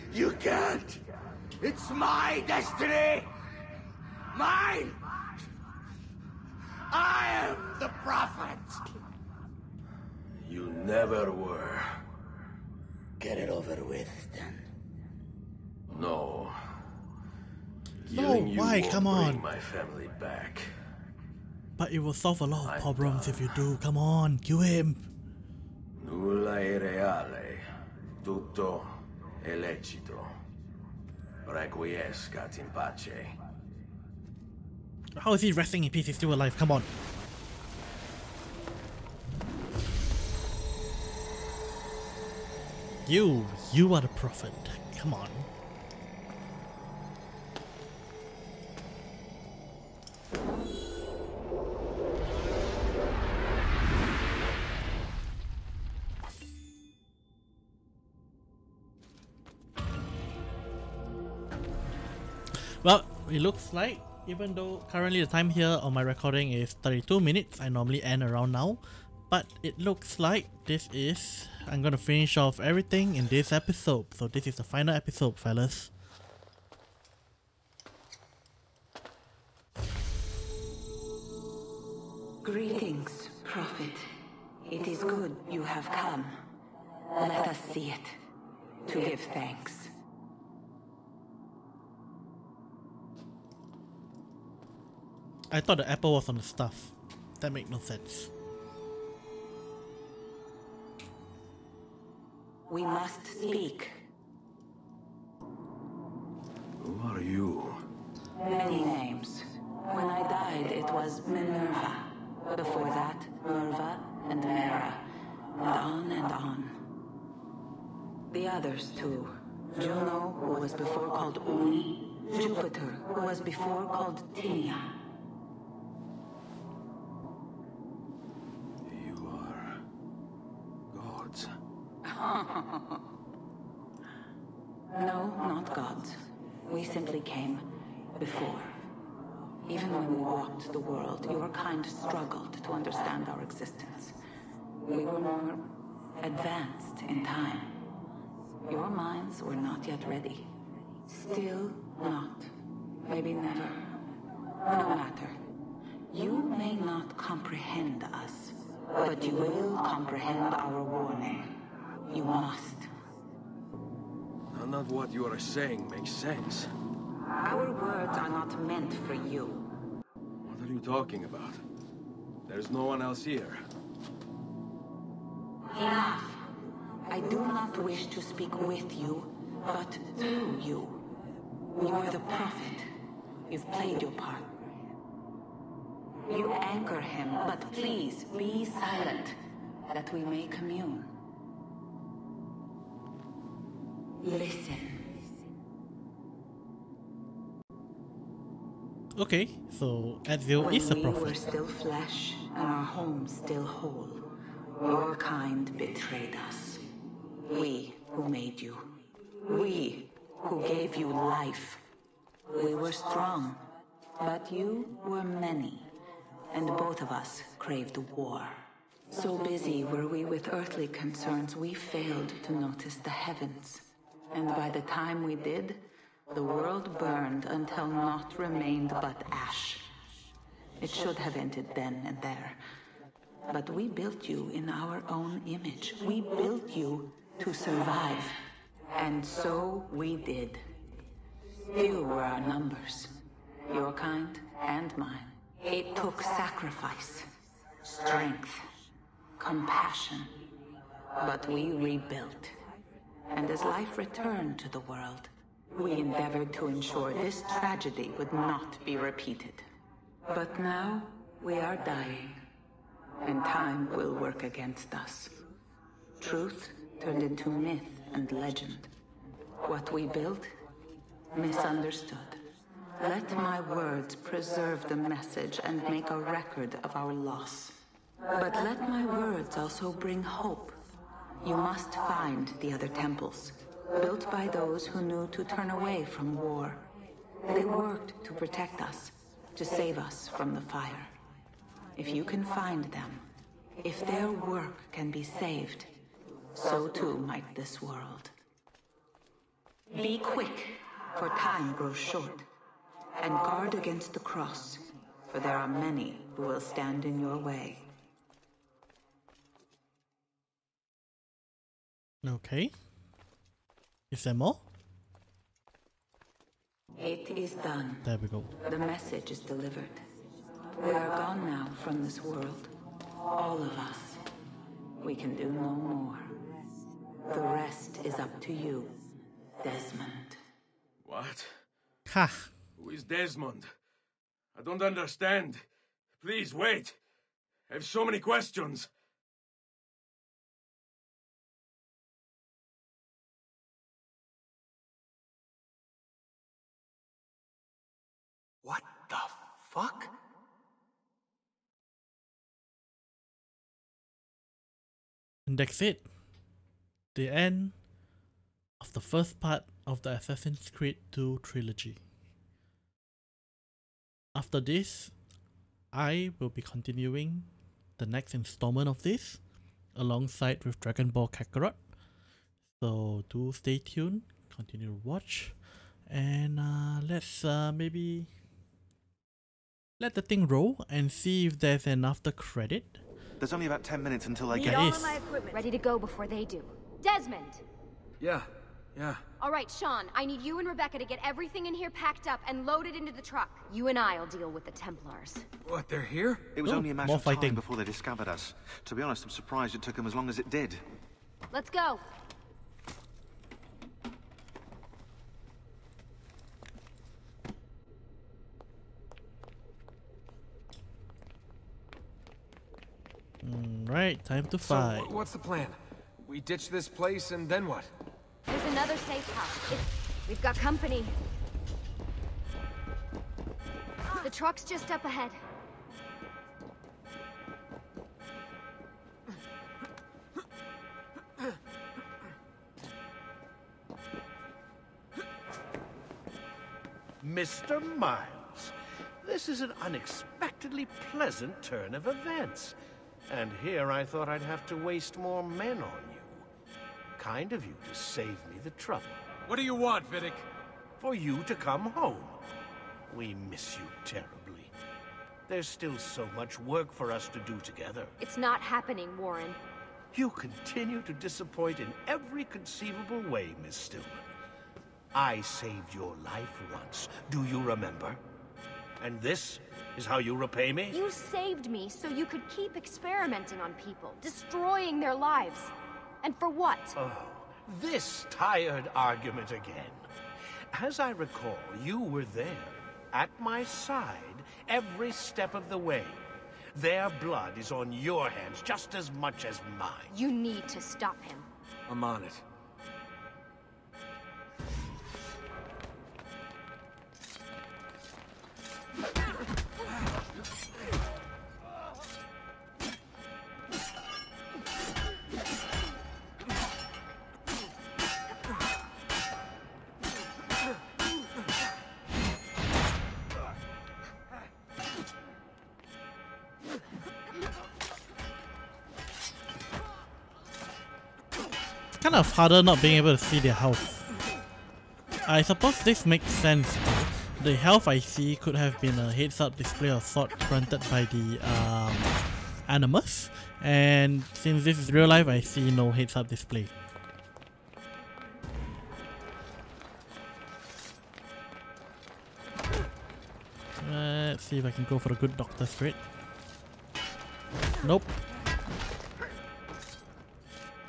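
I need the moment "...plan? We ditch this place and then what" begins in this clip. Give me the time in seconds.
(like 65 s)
415 s.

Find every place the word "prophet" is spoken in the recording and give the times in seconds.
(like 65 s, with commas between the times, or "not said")
8 s, 44 s, 83 s, 182 s, 200 s.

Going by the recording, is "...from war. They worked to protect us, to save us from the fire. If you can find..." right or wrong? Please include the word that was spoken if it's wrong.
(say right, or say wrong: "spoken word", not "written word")
right.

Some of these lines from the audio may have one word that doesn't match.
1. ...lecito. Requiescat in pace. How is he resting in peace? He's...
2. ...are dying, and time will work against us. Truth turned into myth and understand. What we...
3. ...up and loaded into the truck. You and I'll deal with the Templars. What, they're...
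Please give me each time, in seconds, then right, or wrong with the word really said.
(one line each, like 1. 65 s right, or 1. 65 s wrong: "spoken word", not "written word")
1. 29 s right
2. 261 s wrong: "legend", not "understand"
3. 392 s right.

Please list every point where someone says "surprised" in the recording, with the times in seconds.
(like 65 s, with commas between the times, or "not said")
399 s.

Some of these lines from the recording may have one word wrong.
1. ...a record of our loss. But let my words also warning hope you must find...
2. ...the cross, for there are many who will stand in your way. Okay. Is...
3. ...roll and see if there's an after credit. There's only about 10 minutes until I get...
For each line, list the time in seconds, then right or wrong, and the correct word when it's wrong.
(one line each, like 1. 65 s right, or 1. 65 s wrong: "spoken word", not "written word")
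1. 276 s wrong: "bring", not "warning"
2. 304 s right
3. 380 s right.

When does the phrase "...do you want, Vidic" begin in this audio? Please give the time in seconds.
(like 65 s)
449 s.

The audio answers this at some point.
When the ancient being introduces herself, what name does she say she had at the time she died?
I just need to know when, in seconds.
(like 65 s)
111 s.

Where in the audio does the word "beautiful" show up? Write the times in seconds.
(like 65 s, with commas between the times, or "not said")
not said.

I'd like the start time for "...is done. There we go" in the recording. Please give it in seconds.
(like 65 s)
317 s.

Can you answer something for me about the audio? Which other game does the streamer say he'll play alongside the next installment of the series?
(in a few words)
Dragon Ball Kakarot.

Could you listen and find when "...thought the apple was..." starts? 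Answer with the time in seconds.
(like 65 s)
95 s.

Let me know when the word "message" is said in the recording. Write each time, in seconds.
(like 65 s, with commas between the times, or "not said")
274 s, 318 s.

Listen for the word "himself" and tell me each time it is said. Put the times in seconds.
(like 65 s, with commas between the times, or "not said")
not said.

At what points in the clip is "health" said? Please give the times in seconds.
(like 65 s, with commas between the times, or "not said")
523 s, 527 s.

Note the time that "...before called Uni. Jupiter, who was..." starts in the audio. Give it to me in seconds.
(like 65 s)
120 s.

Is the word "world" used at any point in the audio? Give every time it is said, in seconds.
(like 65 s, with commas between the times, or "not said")
140 s, 226 s, 254 s, 297 s, 322 s.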